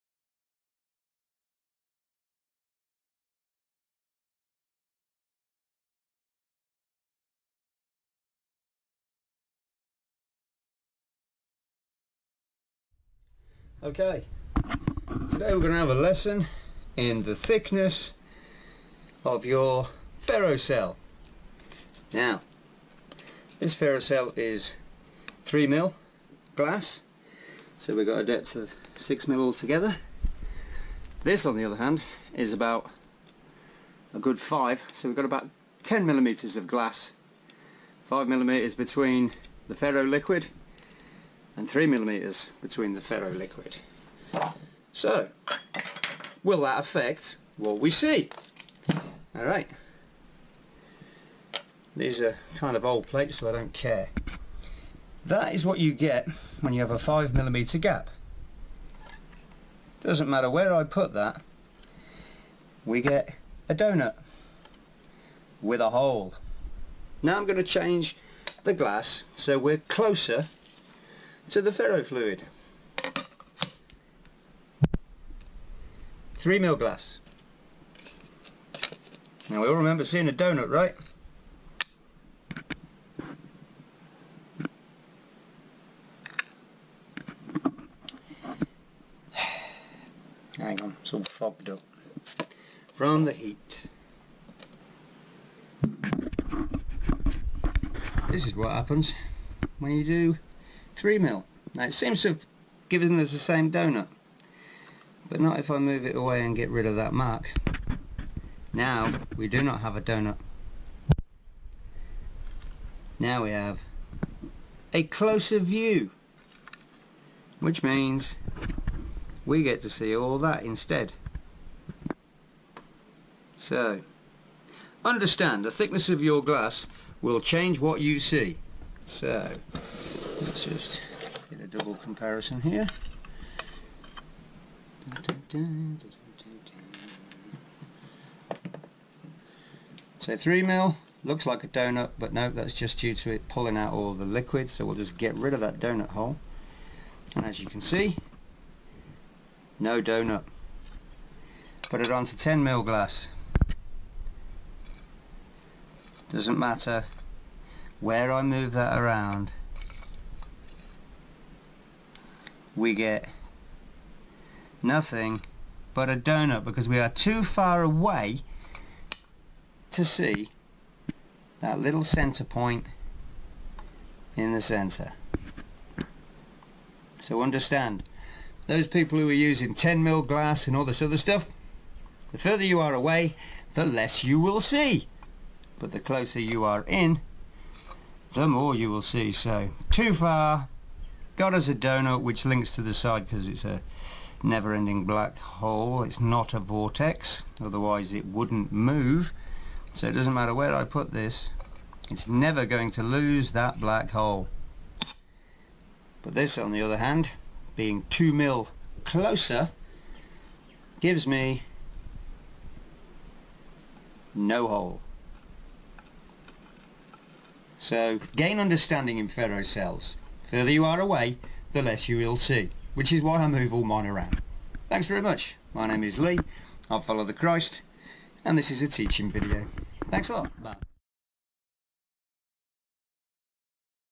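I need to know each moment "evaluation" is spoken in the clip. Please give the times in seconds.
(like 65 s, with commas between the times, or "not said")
not said.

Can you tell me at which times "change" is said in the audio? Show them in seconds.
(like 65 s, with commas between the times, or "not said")
67 s, 127 s.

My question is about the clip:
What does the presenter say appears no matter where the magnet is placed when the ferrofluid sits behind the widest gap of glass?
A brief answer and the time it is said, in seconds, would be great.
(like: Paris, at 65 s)
a donut with a hole, at 63 s.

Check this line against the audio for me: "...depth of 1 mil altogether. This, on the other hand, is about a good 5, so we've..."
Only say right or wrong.
wrong.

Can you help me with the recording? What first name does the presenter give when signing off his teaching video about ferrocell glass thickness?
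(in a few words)
Lee.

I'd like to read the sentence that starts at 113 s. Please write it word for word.
Now we have a closer view.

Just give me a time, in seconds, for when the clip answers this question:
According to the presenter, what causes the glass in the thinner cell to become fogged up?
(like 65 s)
92 s.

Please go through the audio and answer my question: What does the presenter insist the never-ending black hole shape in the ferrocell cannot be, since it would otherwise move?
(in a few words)
A vortex.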